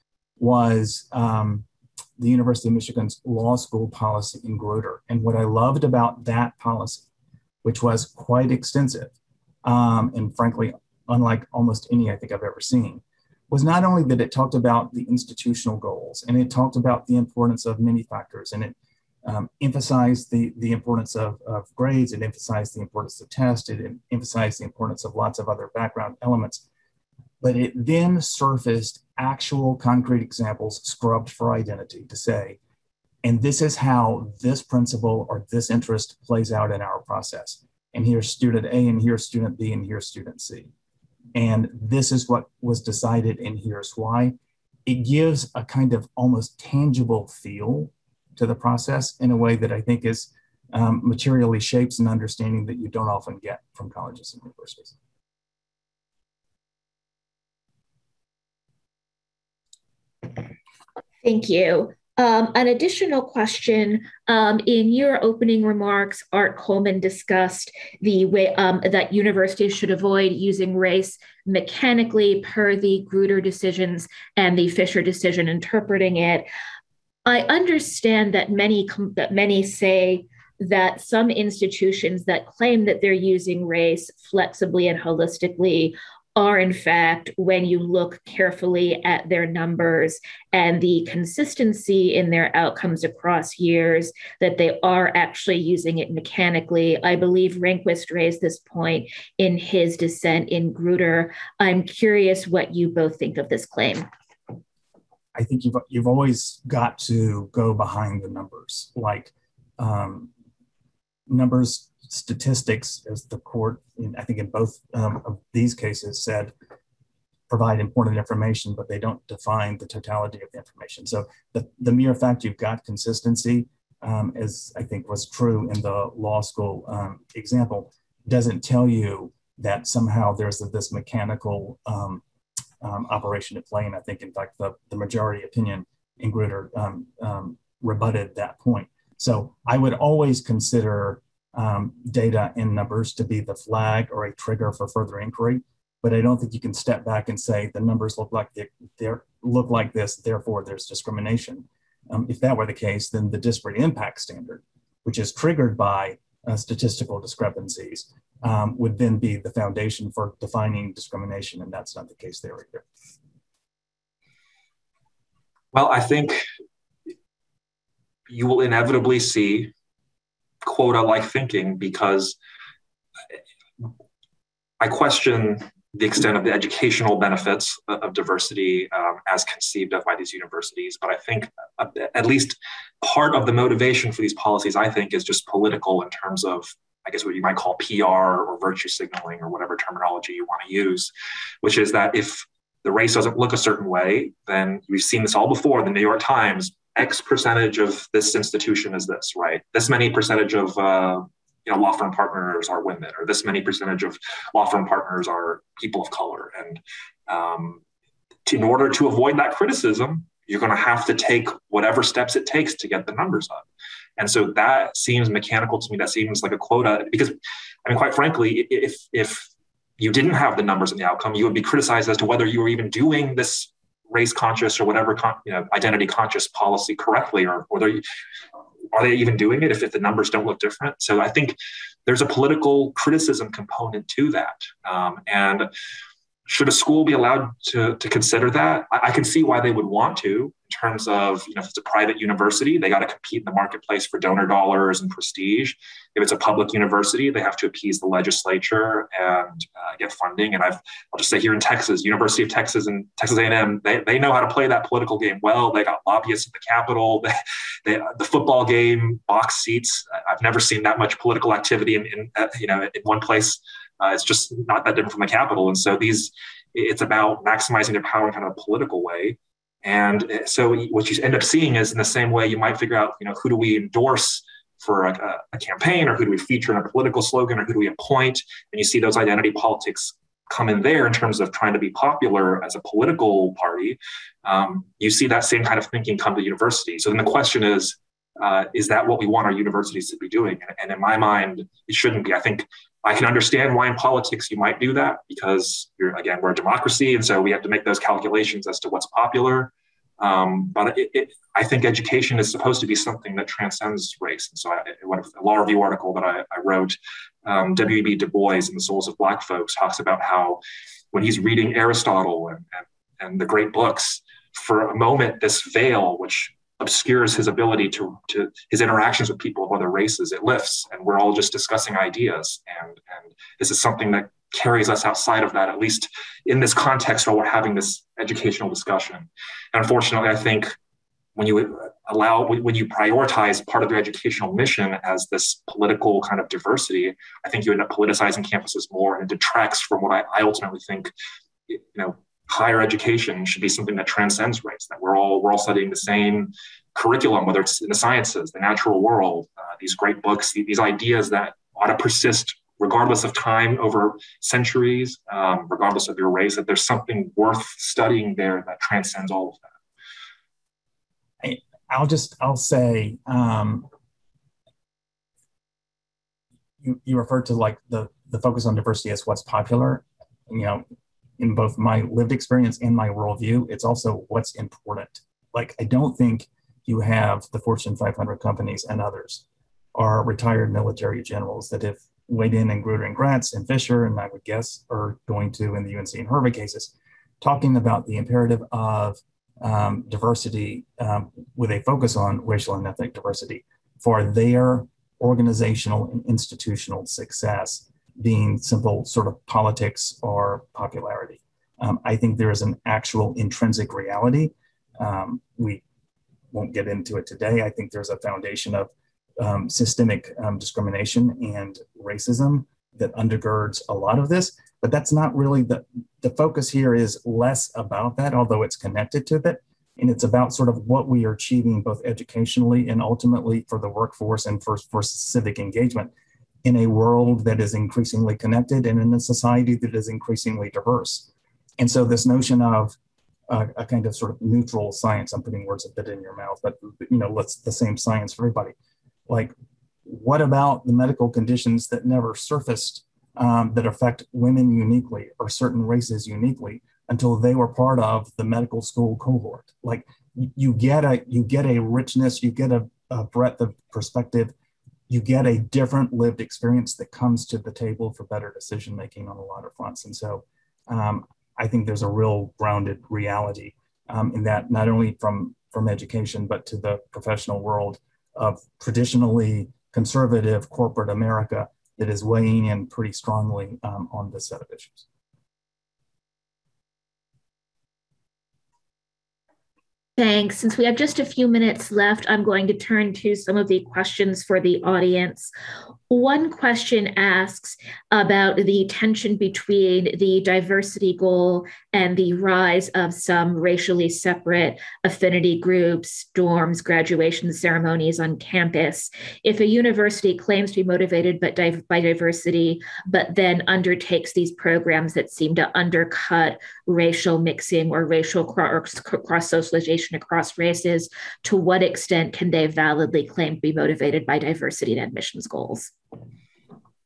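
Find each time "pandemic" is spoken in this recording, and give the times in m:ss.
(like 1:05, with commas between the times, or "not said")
not said.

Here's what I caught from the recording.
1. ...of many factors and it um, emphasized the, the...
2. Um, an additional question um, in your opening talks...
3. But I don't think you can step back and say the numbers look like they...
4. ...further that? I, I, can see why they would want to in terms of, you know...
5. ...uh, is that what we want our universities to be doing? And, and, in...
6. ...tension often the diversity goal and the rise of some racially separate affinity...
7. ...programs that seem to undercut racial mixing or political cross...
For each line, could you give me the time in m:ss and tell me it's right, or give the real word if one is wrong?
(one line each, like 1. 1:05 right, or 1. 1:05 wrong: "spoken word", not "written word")
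1. 0:17 right
2. 1:02 wrong: "remarks", not "talks"
3. 2:26 right
4. 3:58 wrong: "consider", not "further"
5. 4:48 right
6. 8:08 wrong: "between", not "often"
7. 8:24 wrong: "racial", not "political".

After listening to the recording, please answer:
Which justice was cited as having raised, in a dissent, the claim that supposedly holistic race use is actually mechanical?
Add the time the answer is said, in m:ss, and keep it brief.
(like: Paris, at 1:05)
Rehnquist, at 1:37.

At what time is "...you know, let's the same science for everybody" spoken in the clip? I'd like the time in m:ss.
7:17.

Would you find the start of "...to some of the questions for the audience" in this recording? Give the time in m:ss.
8:03.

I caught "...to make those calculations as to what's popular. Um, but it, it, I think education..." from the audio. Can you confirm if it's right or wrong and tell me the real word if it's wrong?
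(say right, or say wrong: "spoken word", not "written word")
right.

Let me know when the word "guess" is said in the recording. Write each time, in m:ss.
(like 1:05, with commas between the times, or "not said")
3:07, 6:24.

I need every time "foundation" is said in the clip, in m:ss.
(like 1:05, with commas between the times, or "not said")
2:39, 6:48.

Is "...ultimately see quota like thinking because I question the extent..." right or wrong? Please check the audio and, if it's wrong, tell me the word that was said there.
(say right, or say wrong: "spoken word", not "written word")
wrong: "inevitably", not "ultimately".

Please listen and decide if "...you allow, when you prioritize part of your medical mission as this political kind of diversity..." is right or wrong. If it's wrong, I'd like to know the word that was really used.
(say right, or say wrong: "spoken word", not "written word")
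wrong: "educational", not "medical".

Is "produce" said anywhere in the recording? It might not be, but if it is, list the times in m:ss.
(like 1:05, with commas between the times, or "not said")
not said.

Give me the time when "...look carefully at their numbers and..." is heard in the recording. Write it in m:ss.
1:27.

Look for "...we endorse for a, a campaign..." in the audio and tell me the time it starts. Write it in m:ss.
4:33.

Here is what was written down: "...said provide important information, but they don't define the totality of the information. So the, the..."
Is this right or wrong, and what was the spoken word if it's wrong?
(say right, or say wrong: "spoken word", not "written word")
right.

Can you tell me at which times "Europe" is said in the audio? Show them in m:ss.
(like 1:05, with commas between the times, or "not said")
not said.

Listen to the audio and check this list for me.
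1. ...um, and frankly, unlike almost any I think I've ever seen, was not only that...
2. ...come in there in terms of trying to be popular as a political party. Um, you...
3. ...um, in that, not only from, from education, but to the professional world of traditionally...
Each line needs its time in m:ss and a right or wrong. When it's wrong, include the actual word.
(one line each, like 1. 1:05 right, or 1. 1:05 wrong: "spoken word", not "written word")
1. 0:09 right
2. 4:40 right
3. 7:44 right.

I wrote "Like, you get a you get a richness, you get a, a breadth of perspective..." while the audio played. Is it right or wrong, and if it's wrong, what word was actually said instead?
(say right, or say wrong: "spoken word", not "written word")
right.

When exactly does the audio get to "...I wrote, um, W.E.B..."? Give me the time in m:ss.
5:06.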